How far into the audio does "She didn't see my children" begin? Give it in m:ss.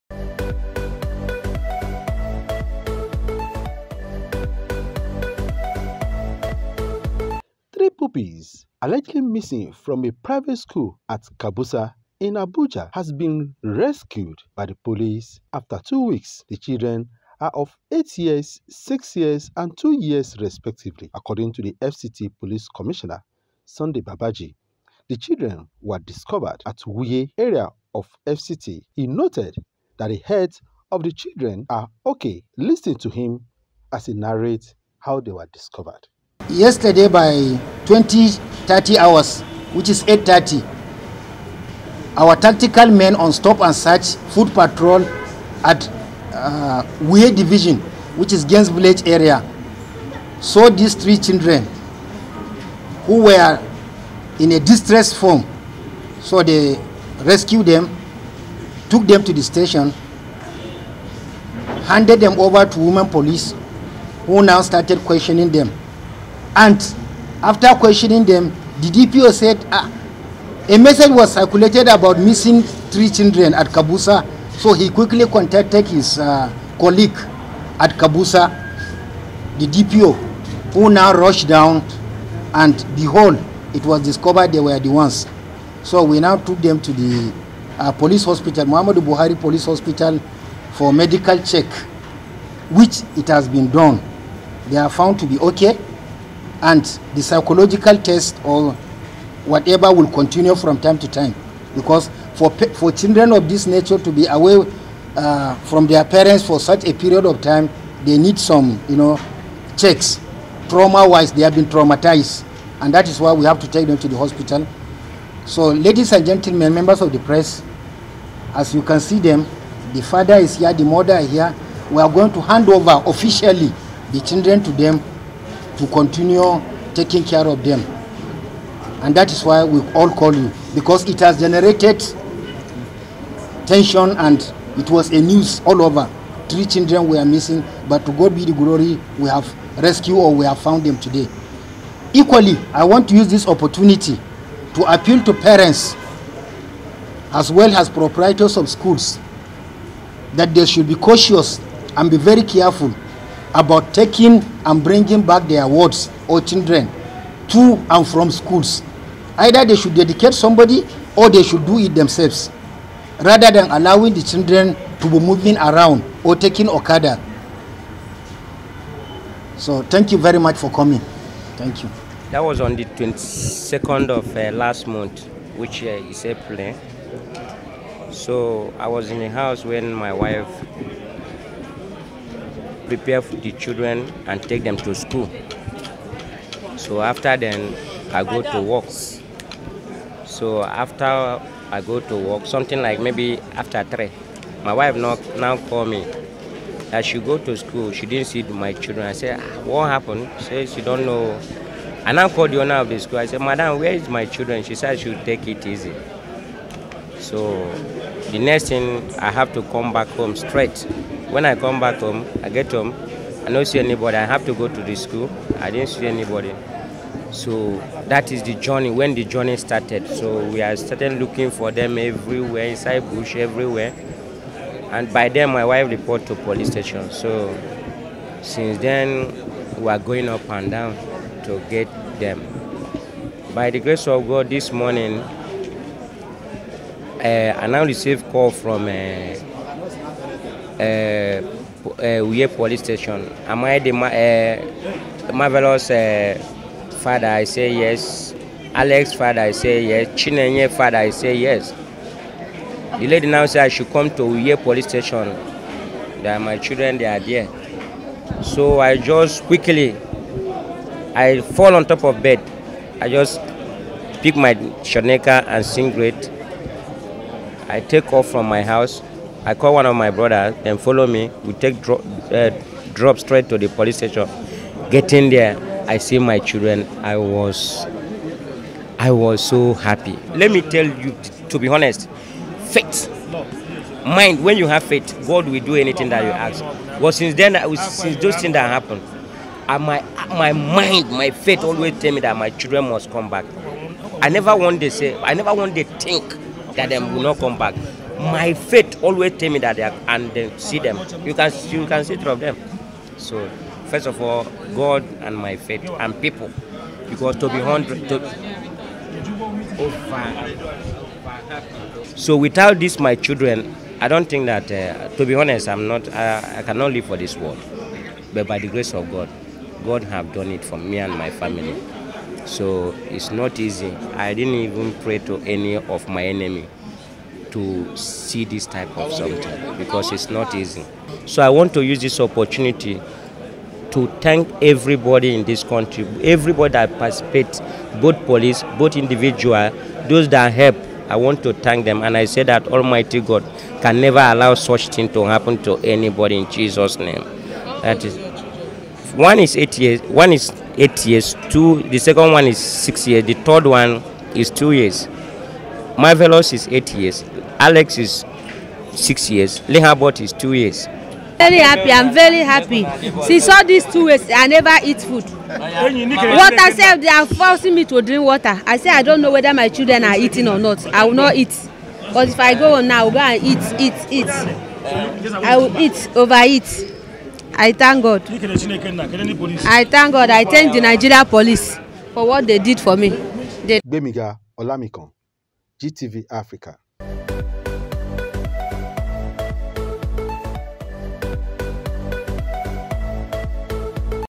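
3:17.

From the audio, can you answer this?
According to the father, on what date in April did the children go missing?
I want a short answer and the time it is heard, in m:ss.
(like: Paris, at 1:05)
22nd, at 2:52.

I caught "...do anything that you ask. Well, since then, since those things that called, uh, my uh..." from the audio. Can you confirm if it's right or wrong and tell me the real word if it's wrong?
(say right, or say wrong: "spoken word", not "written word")
wrong: "happened", not "called".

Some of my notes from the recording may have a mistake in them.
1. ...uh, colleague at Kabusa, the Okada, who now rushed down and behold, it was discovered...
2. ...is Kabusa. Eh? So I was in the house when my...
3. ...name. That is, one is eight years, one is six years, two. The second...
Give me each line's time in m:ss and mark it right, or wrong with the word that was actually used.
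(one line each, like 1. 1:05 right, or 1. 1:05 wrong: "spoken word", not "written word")
1. 1:16 wrong: "DPO", not "Okada"
2. 2:55 wrong: "April", not "Kabusa"
3. 5:46 wrong: "eight", not "six".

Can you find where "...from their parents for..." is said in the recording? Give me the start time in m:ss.
1:45.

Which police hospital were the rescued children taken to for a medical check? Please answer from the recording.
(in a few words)
Muhammad Buhari Police Hospital.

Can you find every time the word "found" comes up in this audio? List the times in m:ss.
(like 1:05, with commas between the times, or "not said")
1:34, 2:20.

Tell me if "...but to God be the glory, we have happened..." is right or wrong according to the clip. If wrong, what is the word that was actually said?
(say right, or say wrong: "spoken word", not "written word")
wrong: "rescued", not "happened".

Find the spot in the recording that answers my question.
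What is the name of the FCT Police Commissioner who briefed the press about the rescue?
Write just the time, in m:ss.
0:23.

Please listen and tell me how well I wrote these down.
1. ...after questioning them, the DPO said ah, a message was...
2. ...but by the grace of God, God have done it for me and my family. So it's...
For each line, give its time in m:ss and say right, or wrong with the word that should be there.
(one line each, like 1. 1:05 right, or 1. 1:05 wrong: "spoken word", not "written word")
1. 1:07 right
2. 5:18 right.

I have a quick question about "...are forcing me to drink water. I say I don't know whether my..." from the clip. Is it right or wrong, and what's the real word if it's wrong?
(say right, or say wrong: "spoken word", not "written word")
right.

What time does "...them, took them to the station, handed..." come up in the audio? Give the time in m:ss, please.
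0:57.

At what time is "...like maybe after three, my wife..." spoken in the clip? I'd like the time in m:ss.
3:12.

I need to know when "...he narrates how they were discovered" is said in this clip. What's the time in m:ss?
0:34.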